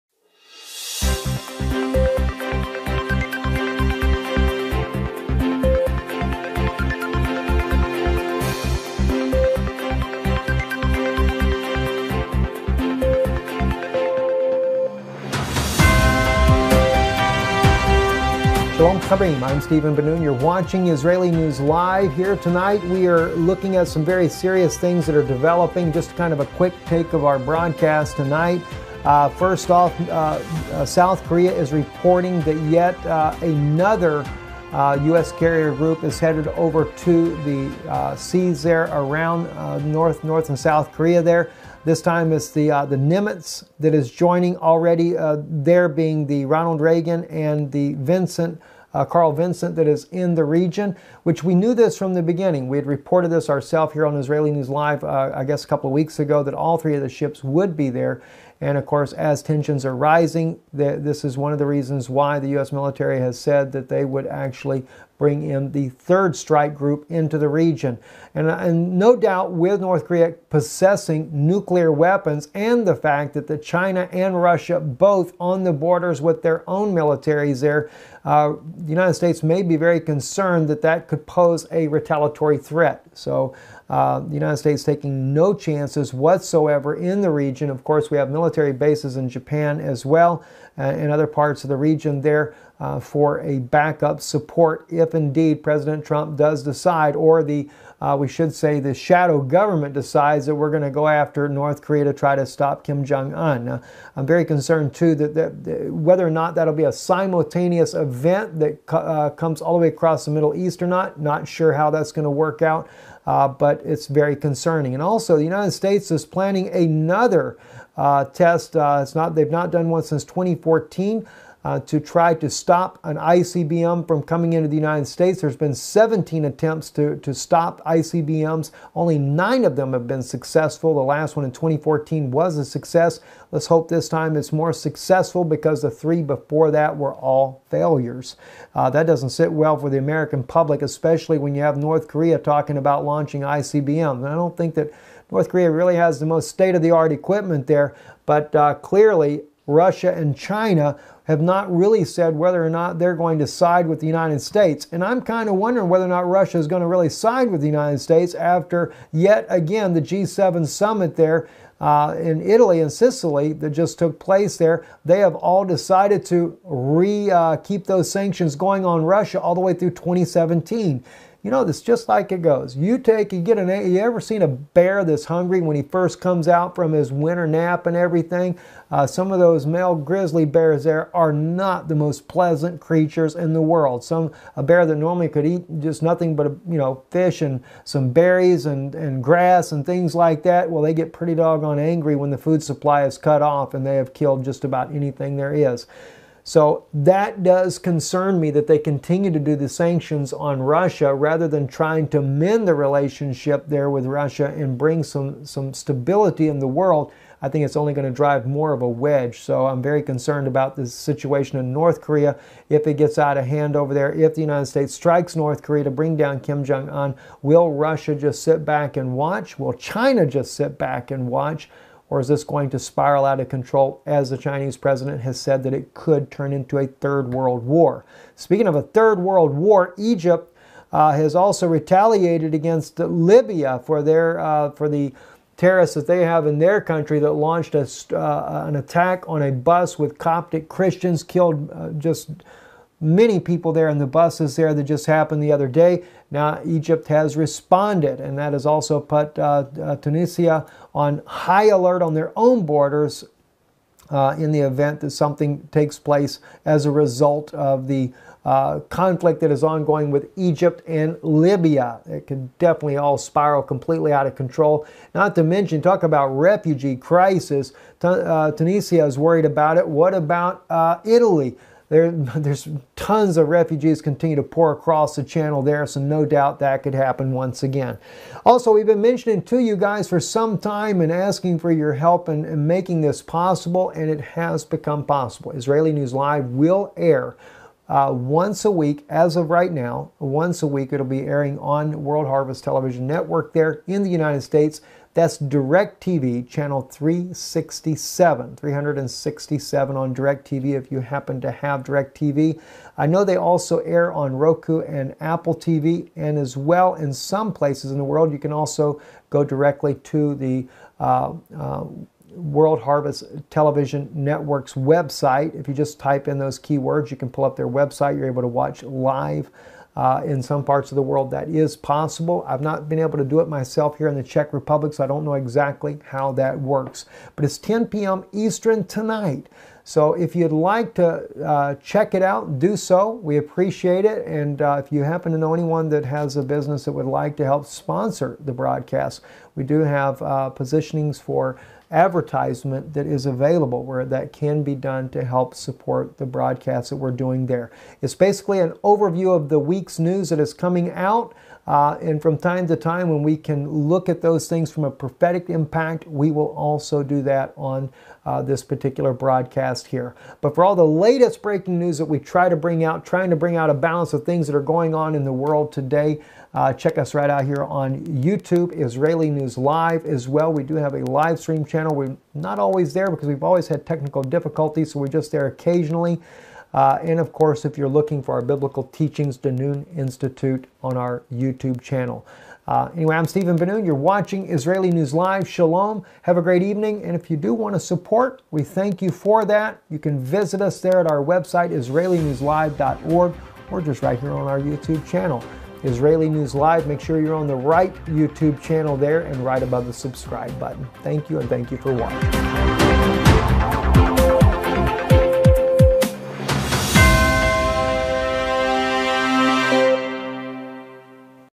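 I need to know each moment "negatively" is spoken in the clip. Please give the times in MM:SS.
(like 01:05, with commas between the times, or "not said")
not said.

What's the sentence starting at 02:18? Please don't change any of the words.
Uh, that doesn't sit well for the American public, especially when you have North Korea talking about launching ICBMs.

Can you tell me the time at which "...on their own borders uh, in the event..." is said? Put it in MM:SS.
04:12.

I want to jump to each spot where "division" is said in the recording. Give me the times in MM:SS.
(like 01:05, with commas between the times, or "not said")
not said.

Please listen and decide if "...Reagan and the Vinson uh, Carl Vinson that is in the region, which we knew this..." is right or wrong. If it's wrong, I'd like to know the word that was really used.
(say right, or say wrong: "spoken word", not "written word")
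right.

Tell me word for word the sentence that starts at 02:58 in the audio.
Uh, some of those male grizzly bears there are not the most pleasant creatures in the world.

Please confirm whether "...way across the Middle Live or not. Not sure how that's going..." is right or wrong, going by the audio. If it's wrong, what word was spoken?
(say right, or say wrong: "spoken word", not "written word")
wrong: "East", not "Live".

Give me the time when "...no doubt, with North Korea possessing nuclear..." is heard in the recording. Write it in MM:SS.
01:08.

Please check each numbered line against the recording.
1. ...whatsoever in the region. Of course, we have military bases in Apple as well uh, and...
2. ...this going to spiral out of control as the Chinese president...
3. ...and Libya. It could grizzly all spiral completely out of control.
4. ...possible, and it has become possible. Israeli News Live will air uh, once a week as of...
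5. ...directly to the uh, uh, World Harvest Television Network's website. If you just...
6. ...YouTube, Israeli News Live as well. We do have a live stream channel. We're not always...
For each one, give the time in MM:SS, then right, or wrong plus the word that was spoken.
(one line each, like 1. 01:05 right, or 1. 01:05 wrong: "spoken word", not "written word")
1. 01:26 wrong: "Japan", not "Apple"
2. 03:42 right
3. 04:20 wrong: "definitely", not "grizzly"
4. 04:43 right
5. 05:09 right
6. 06:08 right.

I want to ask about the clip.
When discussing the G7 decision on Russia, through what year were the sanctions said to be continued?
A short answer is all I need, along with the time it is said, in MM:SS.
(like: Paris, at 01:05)
2017, at 02:49.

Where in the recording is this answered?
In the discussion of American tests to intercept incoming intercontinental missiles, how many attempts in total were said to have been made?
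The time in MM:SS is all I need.
02:05.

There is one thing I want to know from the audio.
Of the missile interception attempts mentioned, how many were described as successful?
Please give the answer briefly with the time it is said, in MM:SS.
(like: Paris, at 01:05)
9, at 02:09.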